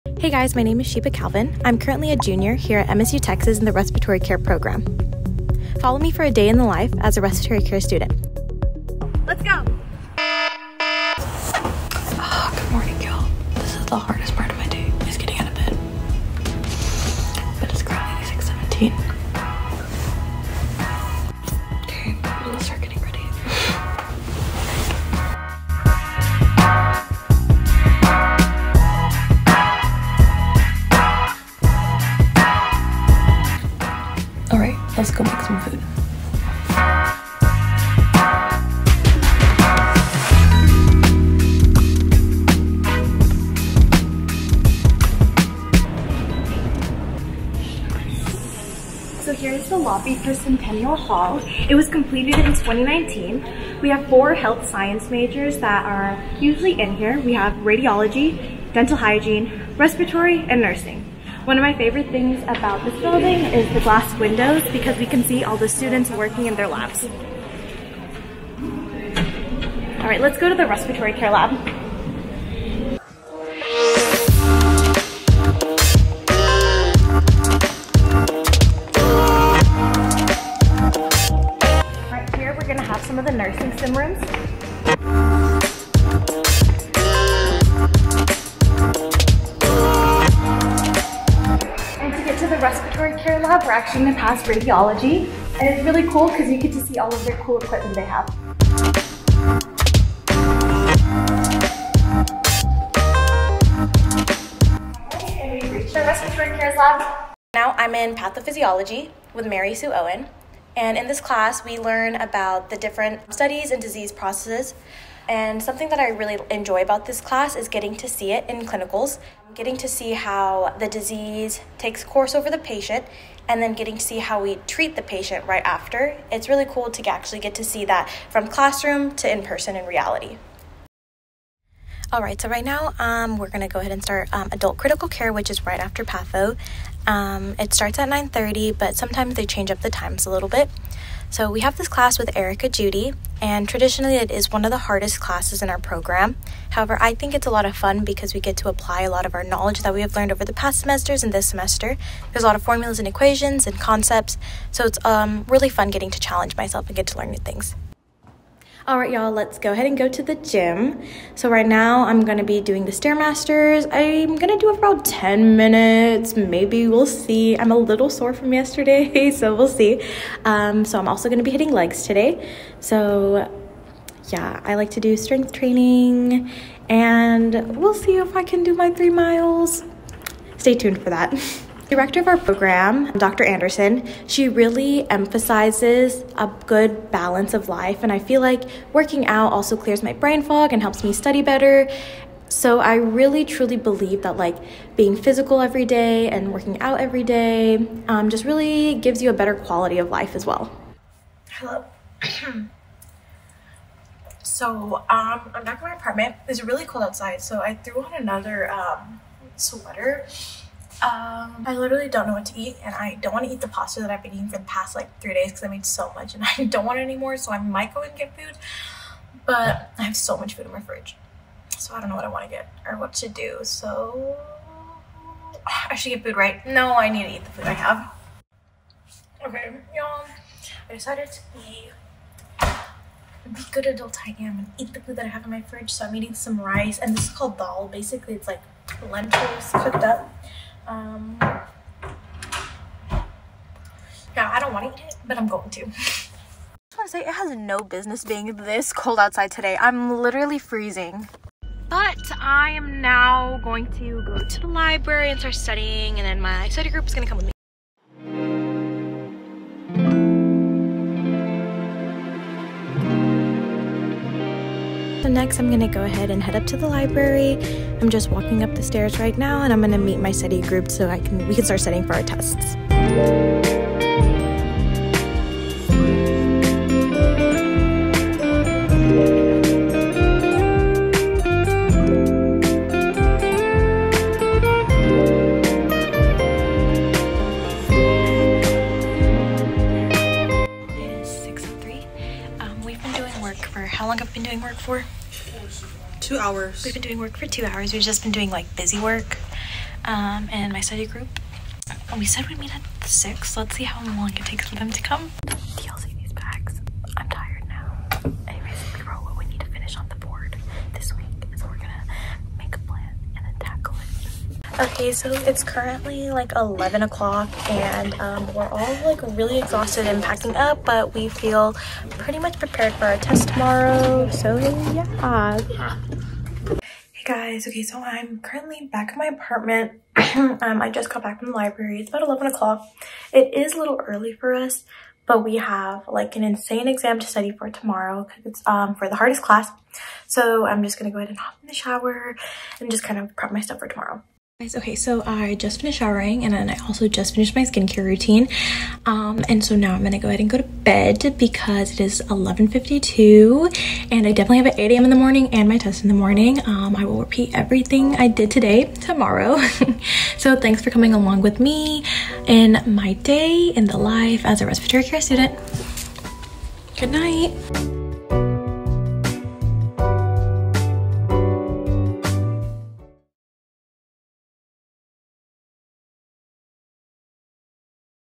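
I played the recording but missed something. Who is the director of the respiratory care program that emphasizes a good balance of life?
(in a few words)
Dr. Anderson.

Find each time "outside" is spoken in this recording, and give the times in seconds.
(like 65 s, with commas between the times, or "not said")
207 s, 249 s.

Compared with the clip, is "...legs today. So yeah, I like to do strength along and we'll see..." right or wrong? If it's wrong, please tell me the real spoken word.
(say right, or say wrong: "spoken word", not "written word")
wrong: "training", not "along".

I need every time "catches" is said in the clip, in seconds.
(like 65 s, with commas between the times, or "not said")
not said.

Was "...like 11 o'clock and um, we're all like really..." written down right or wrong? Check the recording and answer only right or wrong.
right.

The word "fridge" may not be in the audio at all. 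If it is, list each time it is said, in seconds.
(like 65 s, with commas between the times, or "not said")
220 s, 235 s.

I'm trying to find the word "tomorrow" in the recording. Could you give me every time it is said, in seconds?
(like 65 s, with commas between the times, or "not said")
323 s, 337 s, 343 s, 358 s.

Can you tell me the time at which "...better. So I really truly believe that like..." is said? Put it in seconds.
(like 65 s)
191 s.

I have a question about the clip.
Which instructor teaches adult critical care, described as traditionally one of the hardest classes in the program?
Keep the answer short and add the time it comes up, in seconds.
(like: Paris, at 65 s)
Erica Judy, at 142 s.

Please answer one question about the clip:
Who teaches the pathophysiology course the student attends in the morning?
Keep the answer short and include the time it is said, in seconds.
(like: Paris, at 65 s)
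Mary Sue Owen, at 109 s.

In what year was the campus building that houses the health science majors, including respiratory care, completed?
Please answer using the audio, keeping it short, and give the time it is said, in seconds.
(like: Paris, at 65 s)
2019, at 52 s.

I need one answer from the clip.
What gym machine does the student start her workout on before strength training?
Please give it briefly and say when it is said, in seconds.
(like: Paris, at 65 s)
Stairmasters, at 162 s.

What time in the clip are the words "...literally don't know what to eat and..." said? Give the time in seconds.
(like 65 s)
211 s.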